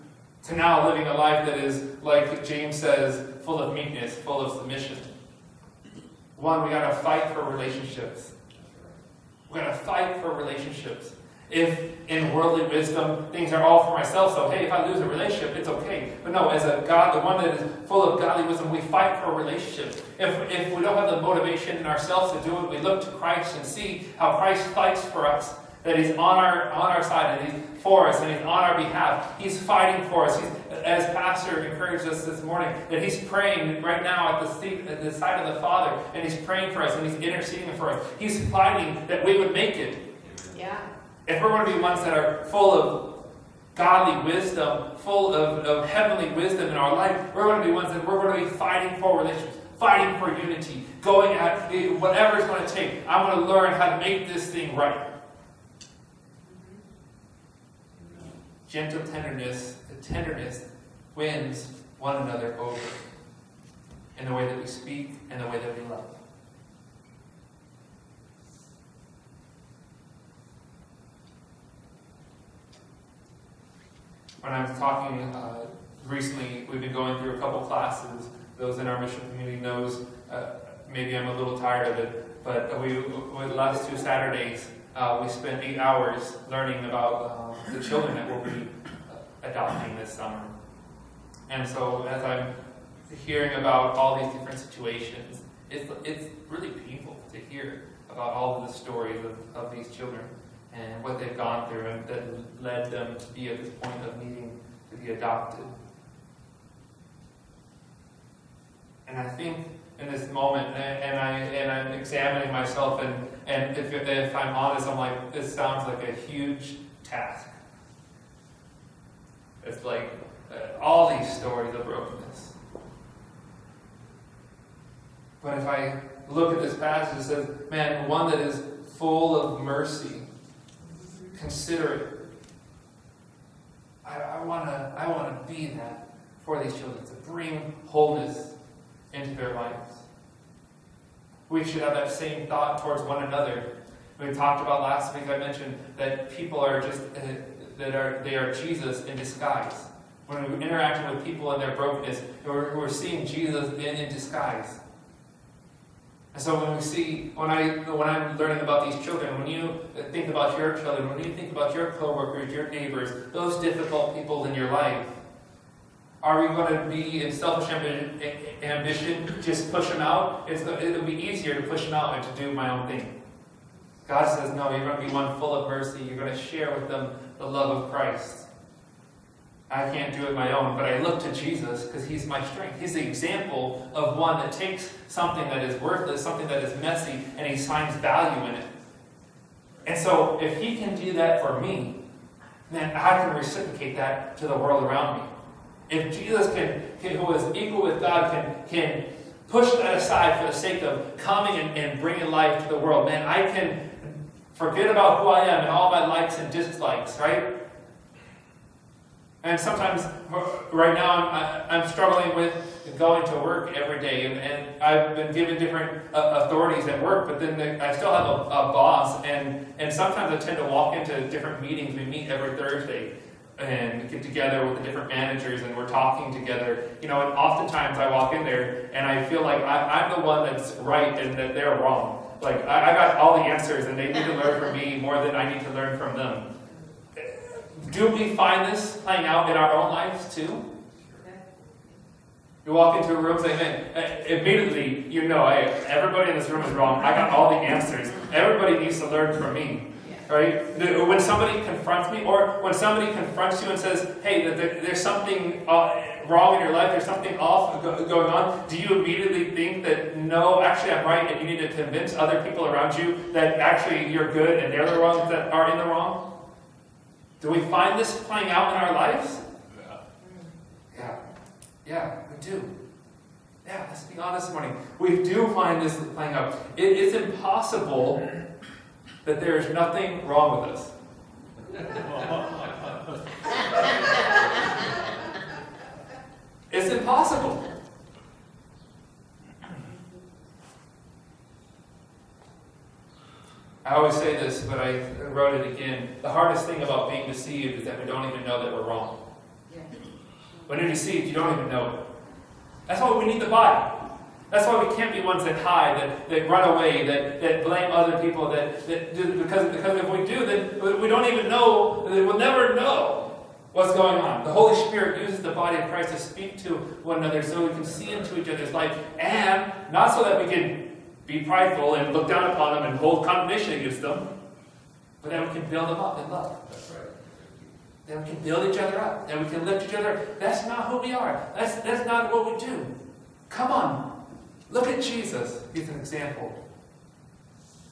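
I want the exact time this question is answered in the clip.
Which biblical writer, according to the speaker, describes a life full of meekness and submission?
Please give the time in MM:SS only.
00:02.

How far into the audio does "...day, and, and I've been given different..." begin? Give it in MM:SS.
03:33.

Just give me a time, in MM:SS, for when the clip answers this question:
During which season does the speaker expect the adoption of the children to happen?
01:29.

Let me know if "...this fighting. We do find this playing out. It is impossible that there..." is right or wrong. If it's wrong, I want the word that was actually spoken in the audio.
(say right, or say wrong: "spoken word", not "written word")
wrong: "morning", not "fighting".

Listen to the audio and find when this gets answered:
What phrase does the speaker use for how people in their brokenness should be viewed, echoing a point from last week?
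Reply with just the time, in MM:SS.
02:28.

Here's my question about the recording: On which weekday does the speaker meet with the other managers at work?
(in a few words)
Thursday.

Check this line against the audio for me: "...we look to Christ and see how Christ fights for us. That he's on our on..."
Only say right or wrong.
right.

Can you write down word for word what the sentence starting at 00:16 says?
But no, as a God, the one that is full of godly wisdom, we fight for a relationship.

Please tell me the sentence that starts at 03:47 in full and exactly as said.
You know, and oftentimes I walk in there, and I feel like I, am the one that's right and that they're wrong.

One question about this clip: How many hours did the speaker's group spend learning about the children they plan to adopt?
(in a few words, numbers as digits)
8.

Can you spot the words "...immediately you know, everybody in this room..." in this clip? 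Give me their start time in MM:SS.
04:04.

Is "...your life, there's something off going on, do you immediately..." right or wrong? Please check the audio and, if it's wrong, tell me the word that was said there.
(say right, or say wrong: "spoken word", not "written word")
right.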